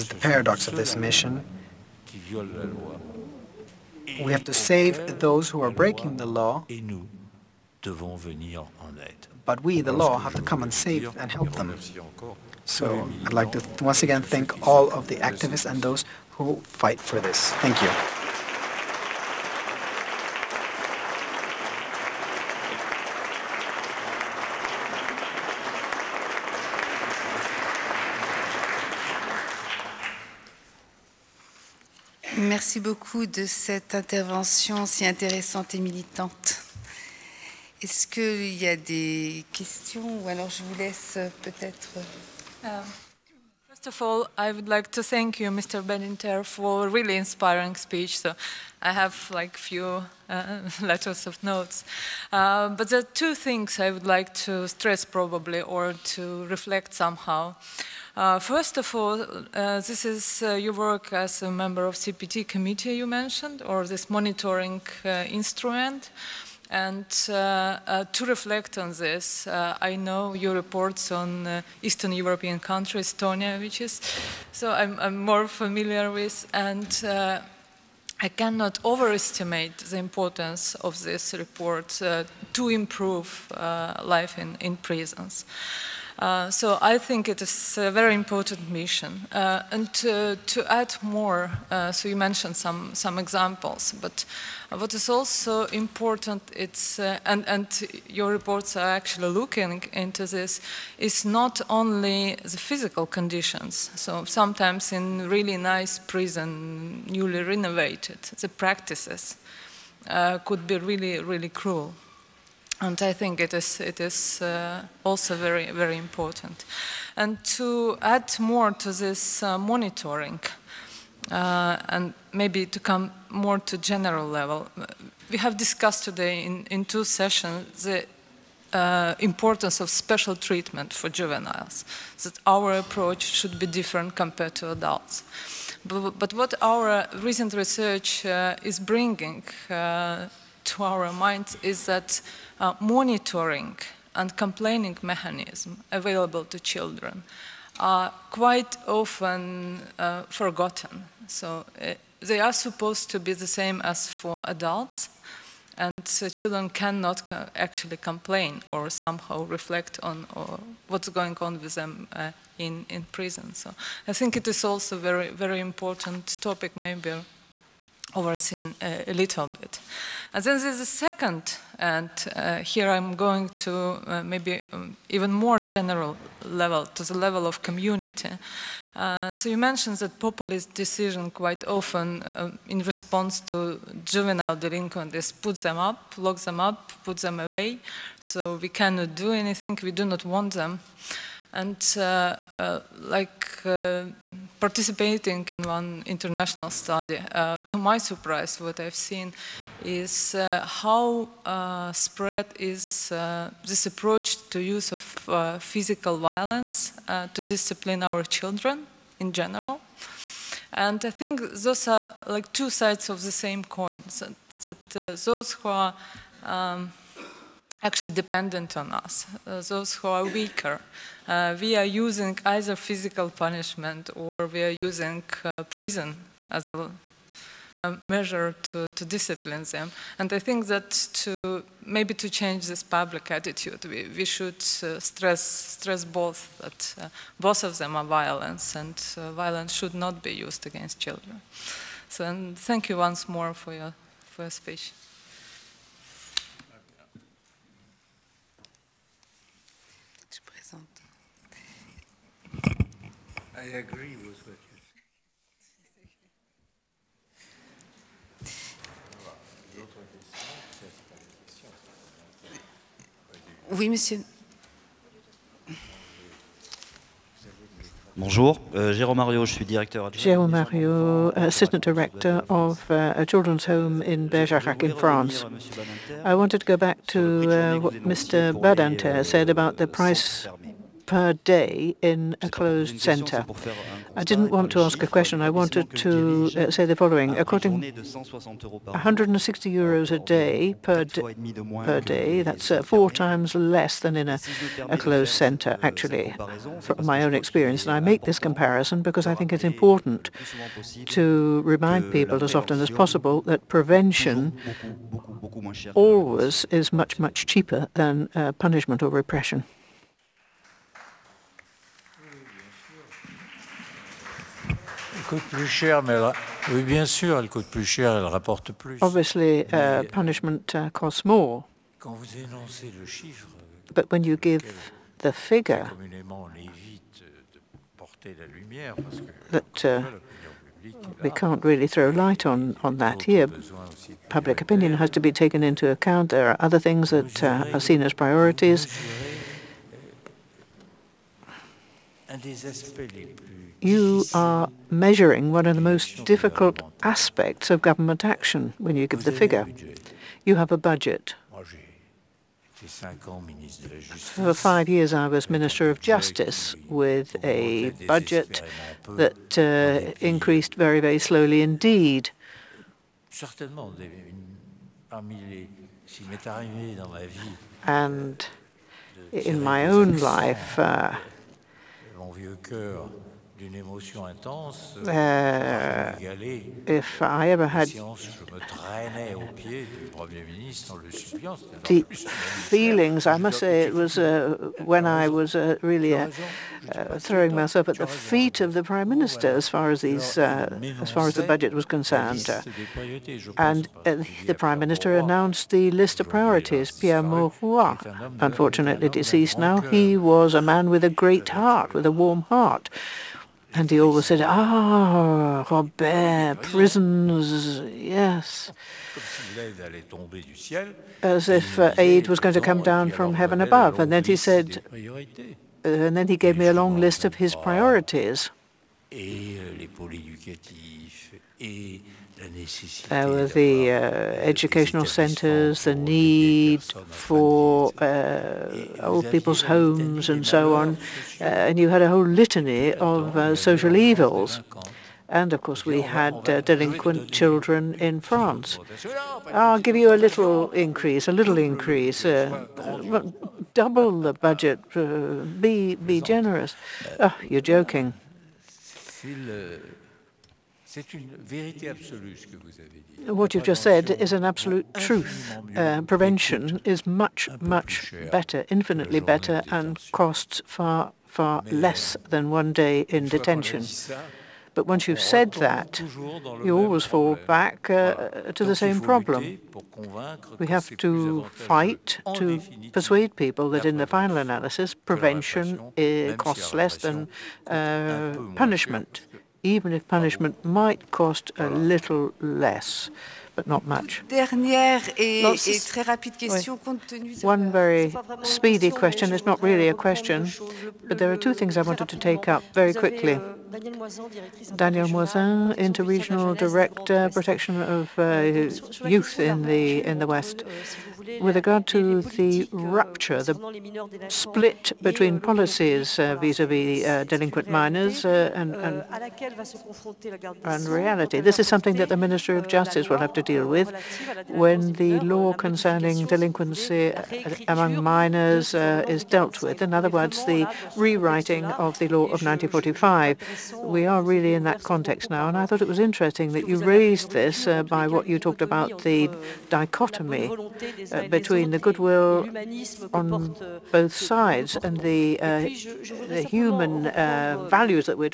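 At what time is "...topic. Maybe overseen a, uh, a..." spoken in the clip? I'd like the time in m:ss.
2:46.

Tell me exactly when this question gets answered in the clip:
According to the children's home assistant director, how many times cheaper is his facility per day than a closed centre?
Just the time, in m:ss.
4:52.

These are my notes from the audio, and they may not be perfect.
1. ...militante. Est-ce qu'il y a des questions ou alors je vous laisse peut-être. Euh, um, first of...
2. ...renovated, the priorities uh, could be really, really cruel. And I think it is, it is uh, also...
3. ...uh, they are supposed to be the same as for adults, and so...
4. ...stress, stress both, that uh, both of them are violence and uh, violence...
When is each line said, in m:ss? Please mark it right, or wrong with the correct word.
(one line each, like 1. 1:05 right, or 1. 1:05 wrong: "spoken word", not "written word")
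1. 0:35 right
2. 1:47 wrong: "practices", not "priorities"
3. 2:31 right
4. 3:54 right.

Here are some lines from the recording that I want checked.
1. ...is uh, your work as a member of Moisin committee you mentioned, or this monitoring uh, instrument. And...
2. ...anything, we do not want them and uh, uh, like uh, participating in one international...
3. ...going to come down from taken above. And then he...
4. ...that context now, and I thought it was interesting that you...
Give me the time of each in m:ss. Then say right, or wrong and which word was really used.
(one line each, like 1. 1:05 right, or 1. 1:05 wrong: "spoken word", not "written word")
1. 1:00 wrong: "CPT", not "Moisin"
2. 3:09 right
3. 6:52 wrong: "heaven", not "taken"
4. 8:44 right.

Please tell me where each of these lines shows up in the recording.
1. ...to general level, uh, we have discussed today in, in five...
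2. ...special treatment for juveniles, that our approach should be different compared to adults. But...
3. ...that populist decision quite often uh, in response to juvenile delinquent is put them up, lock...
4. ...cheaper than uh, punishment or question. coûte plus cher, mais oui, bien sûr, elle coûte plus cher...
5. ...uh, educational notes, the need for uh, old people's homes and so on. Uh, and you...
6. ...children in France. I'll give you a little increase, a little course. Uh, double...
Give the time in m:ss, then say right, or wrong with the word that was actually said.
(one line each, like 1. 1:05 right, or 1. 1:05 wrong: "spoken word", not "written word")
1. 2:03 wrong: "two", not "five"
2. 2:09 right
3. 2:59 right
4. 5:07 wrong: "repression", not "question"
5. 7:03 wrong: "centres", not "notes"
6. 7:17 wrong: "increase", not "course".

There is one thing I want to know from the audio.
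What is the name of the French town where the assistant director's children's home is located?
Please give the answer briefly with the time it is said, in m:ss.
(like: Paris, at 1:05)
Bergerac, at 4:34.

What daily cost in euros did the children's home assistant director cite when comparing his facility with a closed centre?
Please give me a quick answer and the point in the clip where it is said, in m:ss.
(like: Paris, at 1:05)
160 euros, at 4:47.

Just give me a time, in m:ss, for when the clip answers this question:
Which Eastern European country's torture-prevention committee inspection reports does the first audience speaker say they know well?
1:13.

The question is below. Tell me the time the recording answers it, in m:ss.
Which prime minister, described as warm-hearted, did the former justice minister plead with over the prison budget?
6:36.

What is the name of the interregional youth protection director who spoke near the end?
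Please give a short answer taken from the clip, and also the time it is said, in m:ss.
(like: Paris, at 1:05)
Daniel Moisin, at 8:14.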